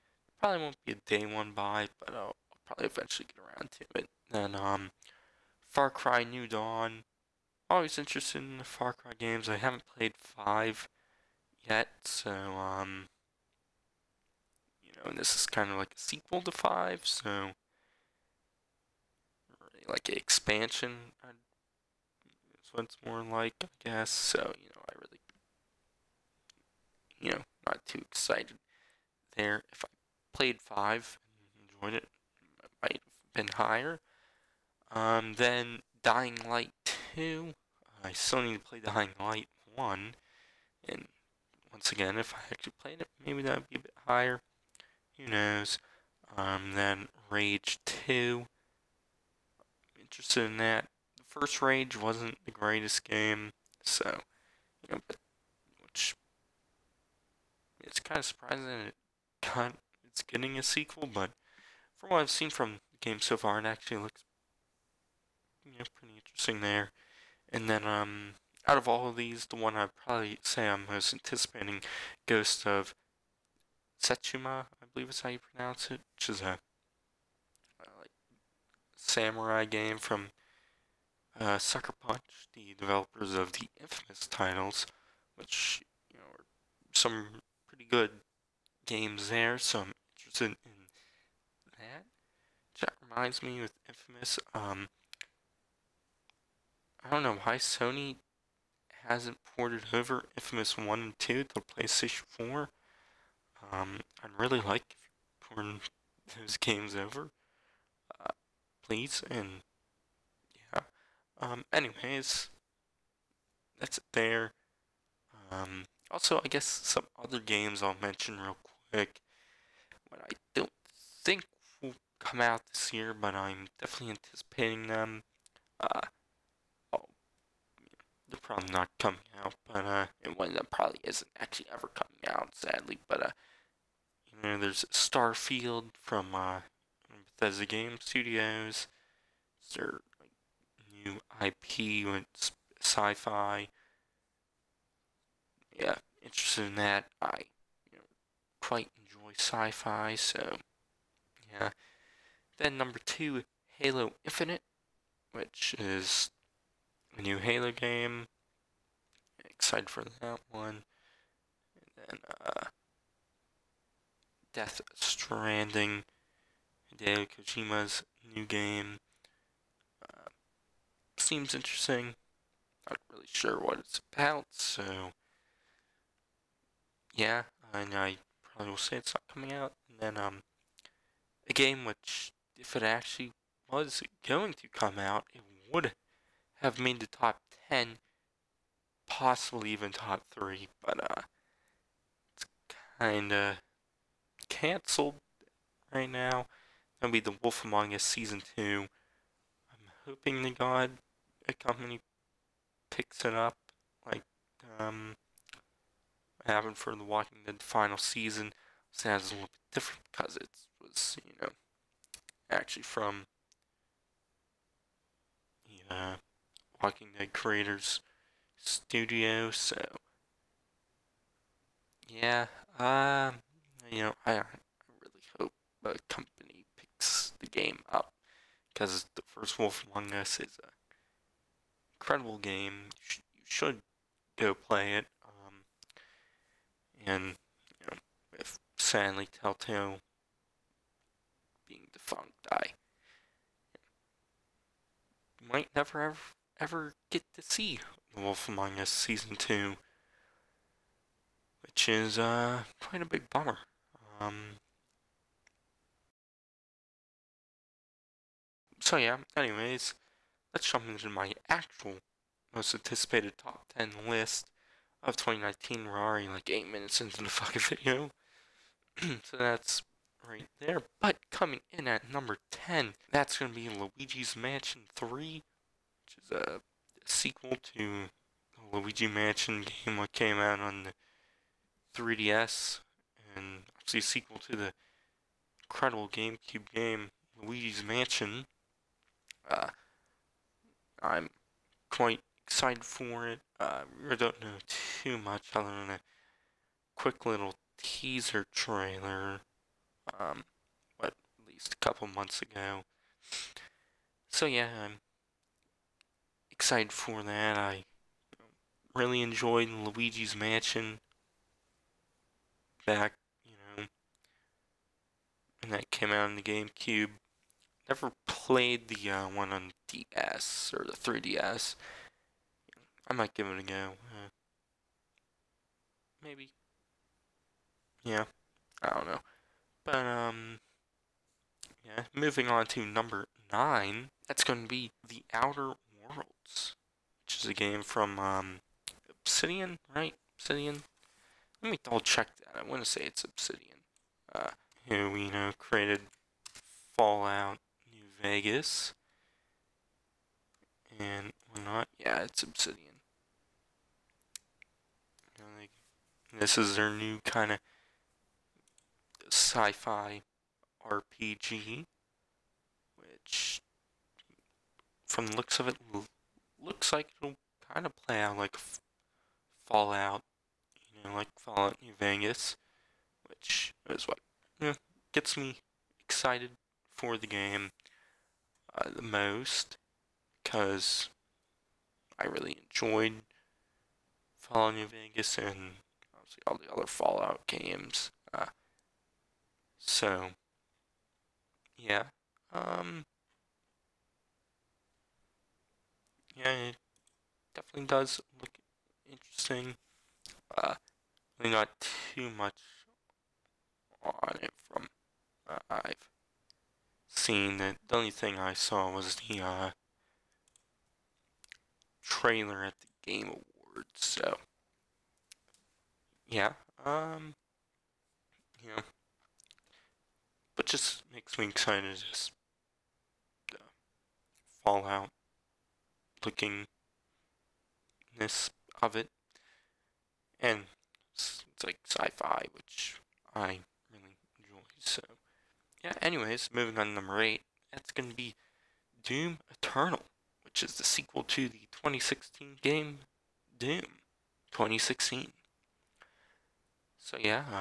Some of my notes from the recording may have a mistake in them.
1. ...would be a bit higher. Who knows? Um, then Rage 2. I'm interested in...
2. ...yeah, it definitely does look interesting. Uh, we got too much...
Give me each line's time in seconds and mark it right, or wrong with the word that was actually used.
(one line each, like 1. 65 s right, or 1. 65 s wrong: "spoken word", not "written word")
1. 43 s right
2. 396 s right.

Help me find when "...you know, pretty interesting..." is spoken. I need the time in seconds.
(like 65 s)
65 s.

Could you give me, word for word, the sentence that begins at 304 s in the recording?
So yeah, I'm excited for that.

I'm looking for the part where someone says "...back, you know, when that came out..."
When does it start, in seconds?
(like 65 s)
312 s.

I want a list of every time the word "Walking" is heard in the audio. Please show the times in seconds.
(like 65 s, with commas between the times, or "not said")
207 s, 216 s.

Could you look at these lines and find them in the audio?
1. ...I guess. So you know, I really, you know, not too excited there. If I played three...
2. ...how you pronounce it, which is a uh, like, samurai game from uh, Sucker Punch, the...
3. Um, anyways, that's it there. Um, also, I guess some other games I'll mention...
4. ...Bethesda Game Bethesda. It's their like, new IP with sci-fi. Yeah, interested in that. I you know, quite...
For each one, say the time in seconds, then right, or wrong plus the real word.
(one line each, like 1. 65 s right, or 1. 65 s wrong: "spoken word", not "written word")
1. 23 s wrong: "five", not "three"
2. 75 s right
3. 111 s right
4. 137 s wrong: "Studios", not "Bethesda".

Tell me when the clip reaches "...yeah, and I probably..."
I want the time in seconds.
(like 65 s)
177 s.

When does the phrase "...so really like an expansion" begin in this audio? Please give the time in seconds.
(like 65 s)
17 s.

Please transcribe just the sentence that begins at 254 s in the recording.
Um, so yeah, anyways, let's jump into my actual most anticipated top 10 list of 2019.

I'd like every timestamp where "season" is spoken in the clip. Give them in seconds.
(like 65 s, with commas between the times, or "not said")
198 s, 207 s, 248 s.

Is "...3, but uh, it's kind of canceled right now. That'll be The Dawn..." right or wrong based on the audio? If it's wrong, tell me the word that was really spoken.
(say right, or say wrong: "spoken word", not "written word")
wrong: "Wolf", not "Dawn".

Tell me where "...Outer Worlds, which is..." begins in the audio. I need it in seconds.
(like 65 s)
335 s.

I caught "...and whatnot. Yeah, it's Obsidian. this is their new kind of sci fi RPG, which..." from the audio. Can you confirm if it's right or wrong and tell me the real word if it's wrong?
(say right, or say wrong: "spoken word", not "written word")
right.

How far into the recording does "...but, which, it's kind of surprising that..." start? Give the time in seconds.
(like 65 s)
55 s.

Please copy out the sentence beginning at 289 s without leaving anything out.
Uh, I'm quite excited for it.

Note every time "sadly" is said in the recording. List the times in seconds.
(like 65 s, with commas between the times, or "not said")
132 s, 238 s.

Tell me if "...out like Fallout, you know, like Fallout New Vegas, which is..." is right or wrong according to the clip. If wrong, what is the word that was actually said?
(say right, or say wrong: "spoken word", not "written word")
right.